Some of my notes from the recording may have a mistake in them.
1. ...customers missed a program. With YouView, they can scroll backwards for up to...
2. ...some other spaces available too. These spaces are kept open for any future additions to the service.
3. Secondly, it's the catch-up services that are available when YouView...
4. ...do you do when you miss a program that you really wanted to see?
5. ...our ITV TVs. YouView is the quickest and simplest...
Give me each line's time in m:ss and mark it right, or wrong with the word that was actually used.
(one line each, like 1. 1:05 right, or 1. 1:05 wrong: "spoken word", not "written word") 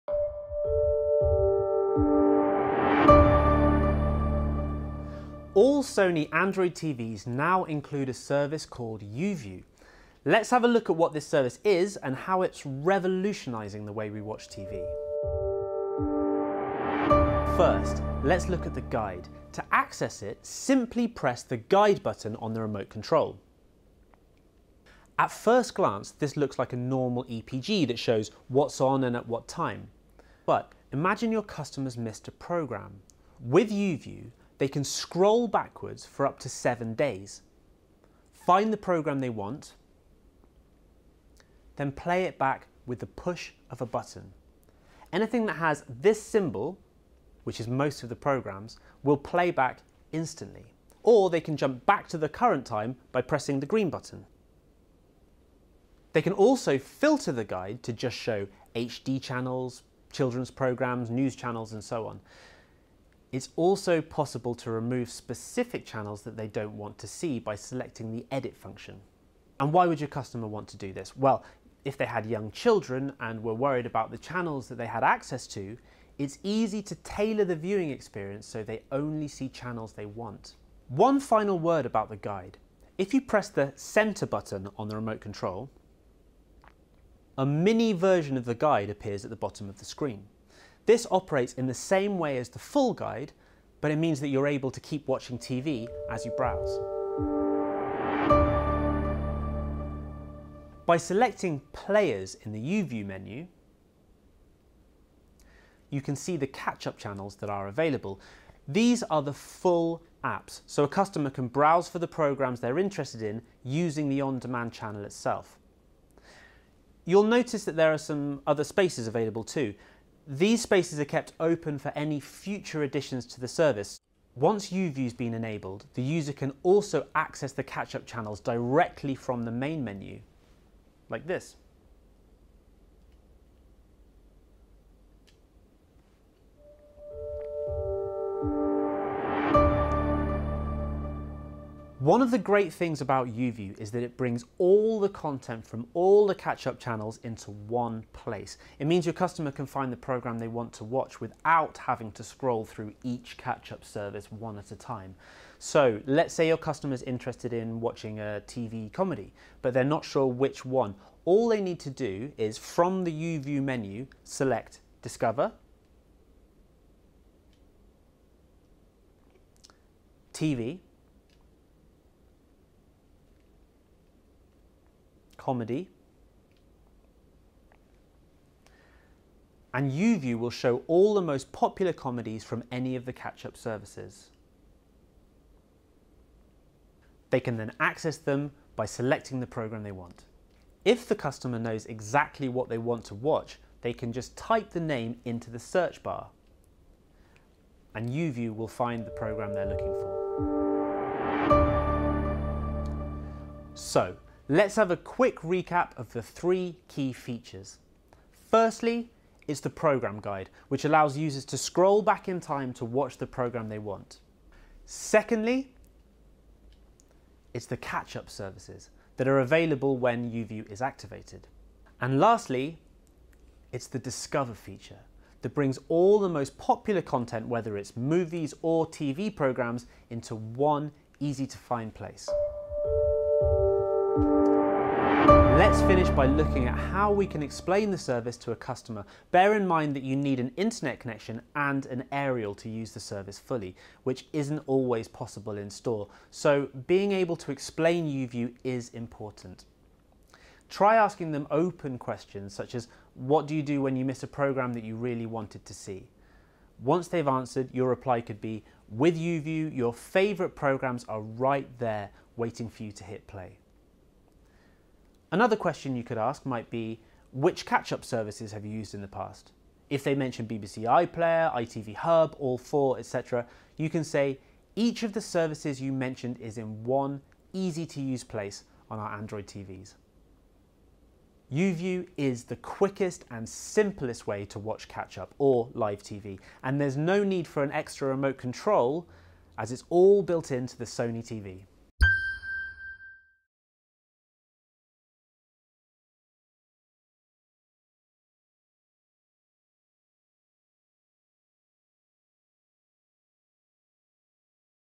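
1. 0:31 right
2. 1:57 right
3. 3:34 right
4. 4:13 right
5. 4:38 wrong: "Android", not "ITV".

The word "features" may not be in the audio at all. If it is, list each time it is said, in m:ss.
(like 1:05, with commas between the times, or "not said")
3:27, 3:44.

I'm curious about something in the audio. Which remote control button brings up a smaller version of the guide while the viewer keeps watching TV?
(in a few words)
center button.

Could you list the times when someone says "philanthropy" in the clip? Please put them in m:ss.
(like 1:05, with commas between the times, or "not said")
not said.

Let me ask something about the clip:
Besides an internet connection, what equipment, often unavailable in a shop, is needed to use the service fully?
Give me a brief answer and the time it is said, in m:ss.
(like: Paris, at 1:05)
an aerial, at 4:01.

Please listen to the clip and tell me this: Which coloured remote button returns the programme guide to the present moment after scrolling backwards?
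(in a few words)
green.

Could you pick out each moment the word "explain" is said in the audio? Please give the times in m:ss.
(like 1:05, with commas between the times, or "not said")
3:57, 4:07.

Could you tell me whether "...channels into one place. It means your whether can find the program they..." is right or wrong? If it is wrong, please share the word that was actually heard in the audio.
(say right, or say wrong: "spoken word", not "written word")
wrong: "customer", not "whether".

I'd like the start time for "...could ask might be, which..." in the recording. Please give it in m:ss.
4:26.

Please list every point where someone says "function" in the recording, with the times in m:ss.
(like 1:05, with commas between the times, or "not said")
1:08.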